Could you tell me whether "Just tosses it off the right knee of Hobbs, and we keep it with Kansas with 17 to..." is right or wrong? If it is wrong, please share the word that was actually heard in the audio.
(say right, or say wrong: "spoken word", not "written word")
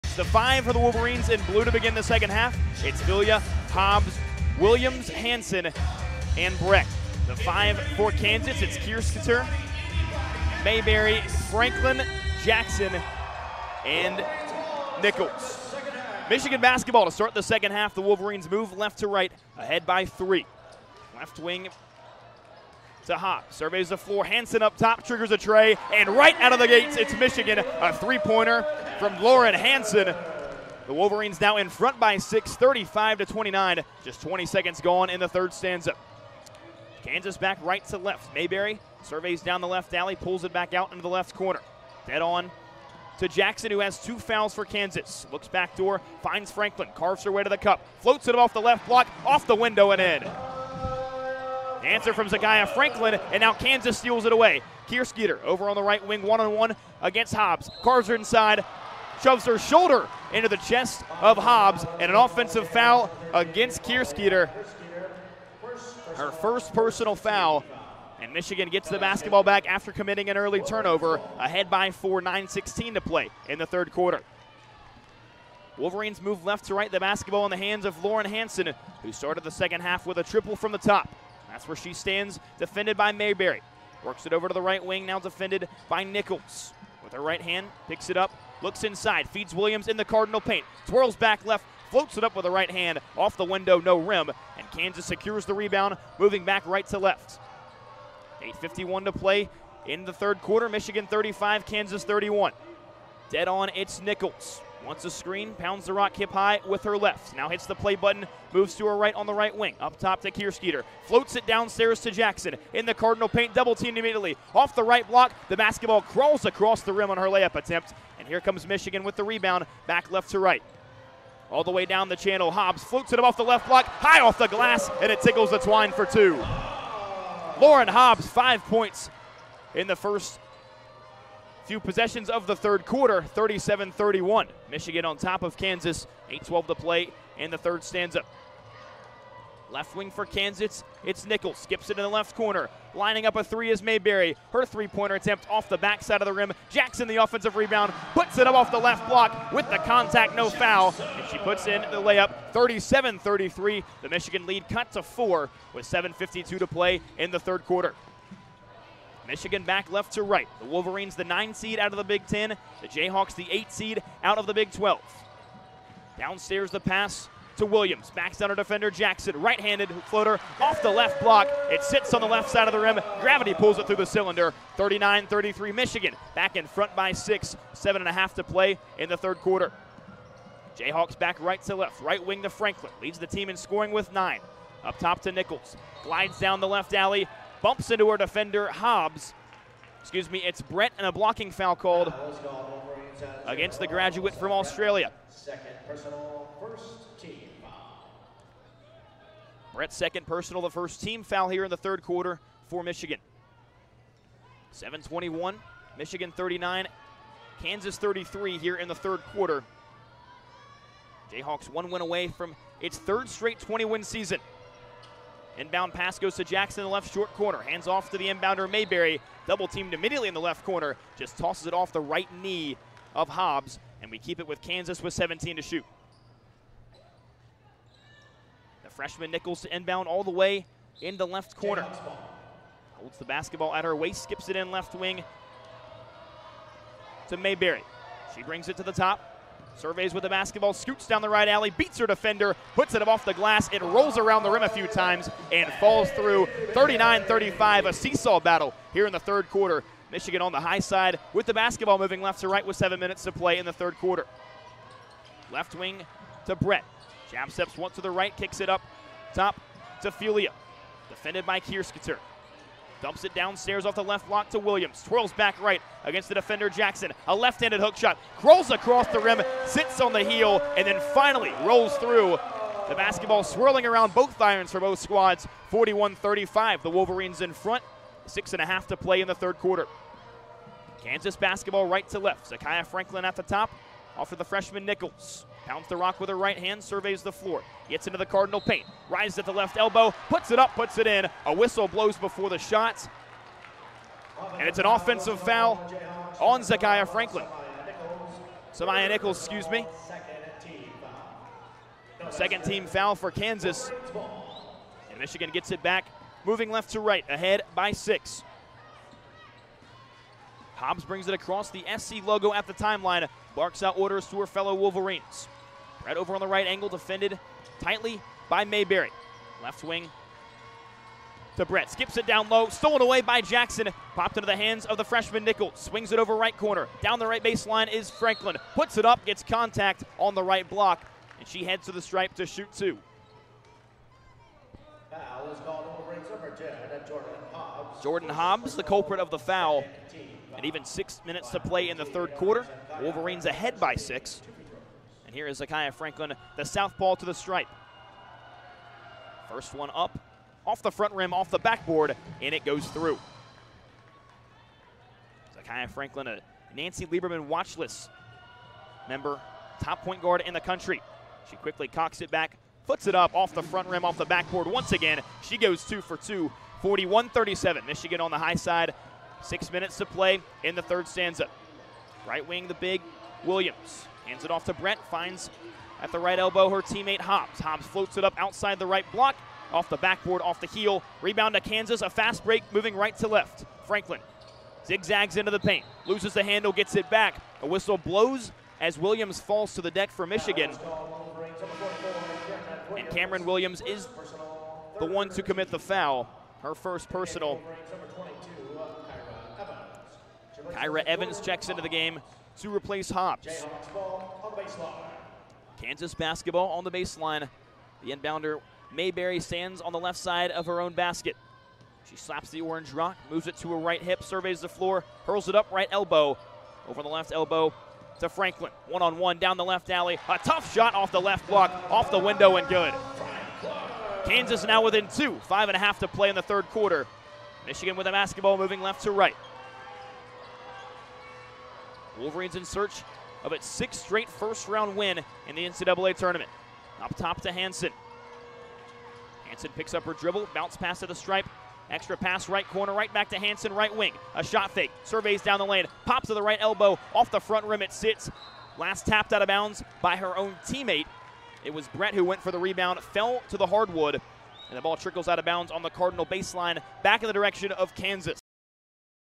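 right.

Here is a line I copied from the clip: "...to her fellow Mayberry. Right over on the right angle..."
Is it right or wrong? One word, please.
wrong.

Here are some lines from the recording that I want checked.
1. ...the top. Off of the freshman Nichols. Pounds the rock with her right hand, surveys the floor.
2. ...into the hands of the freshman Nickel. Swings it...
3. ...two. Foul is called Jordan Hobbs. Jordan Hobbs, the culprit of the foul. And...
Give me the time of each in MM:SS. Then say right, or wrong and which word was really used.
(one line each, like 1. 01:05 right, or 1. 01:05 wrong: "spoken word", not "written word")
1. 04:43 right
2. 05:24 right
3. 05:32 right.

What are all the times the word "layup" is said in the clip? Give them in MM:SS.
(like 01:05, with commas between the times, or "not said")
01:57, 02:32.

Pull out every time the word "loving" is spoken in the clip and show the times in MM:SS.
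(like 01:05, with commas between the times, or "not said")
not said.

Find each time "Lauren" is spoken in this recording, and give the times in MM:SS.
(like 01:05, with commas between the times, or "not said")
00:29, 01:18, 02:07.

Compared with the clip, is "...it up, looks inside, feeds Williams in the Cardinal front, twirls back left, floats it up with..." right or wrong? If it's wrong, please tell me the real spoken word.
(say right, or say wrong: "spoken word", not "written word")
wrong: "paint", not "front".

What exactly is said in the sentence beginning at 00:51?
Answer from Zakiyah Franklin, and now Kansas steals it away.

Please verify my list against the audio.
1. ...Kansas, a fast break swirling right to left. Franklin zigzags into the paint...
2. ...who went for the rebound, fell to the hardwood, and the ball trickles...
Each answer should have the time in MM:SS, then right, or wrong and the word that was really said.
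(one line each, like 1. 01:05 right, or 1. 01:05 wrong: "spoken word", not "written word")
1. 06:21 wrong: "moving", not "swirling"
2. 07:32 right.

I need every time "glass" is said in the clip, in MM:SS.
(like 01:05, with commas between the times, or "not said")
02:04, 04:03.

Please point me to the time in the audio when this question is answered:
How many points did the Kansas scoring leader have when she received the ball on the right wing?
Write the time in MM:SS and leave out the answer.
03:04.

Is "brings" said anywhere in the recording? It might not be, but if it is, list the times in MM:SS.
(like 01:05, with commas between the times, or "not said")
03:58, 05:11.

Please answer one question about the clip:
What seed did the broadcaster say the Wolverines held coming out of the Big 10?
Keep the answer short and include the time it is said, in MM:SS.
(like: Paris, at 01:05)
9, at 02:41.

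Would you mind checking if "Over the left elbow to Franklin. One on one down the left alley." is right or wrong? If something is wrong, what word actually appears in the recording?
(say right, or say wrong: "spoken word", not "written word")
right.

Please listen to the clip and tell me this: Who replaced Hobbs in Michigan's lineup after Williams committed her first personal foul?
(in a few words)
Chyra Evans.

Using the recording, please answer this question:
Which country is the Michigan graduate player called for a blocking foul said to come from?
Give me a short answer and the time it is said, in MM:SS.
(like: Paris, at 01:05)
Australia, at 03:14.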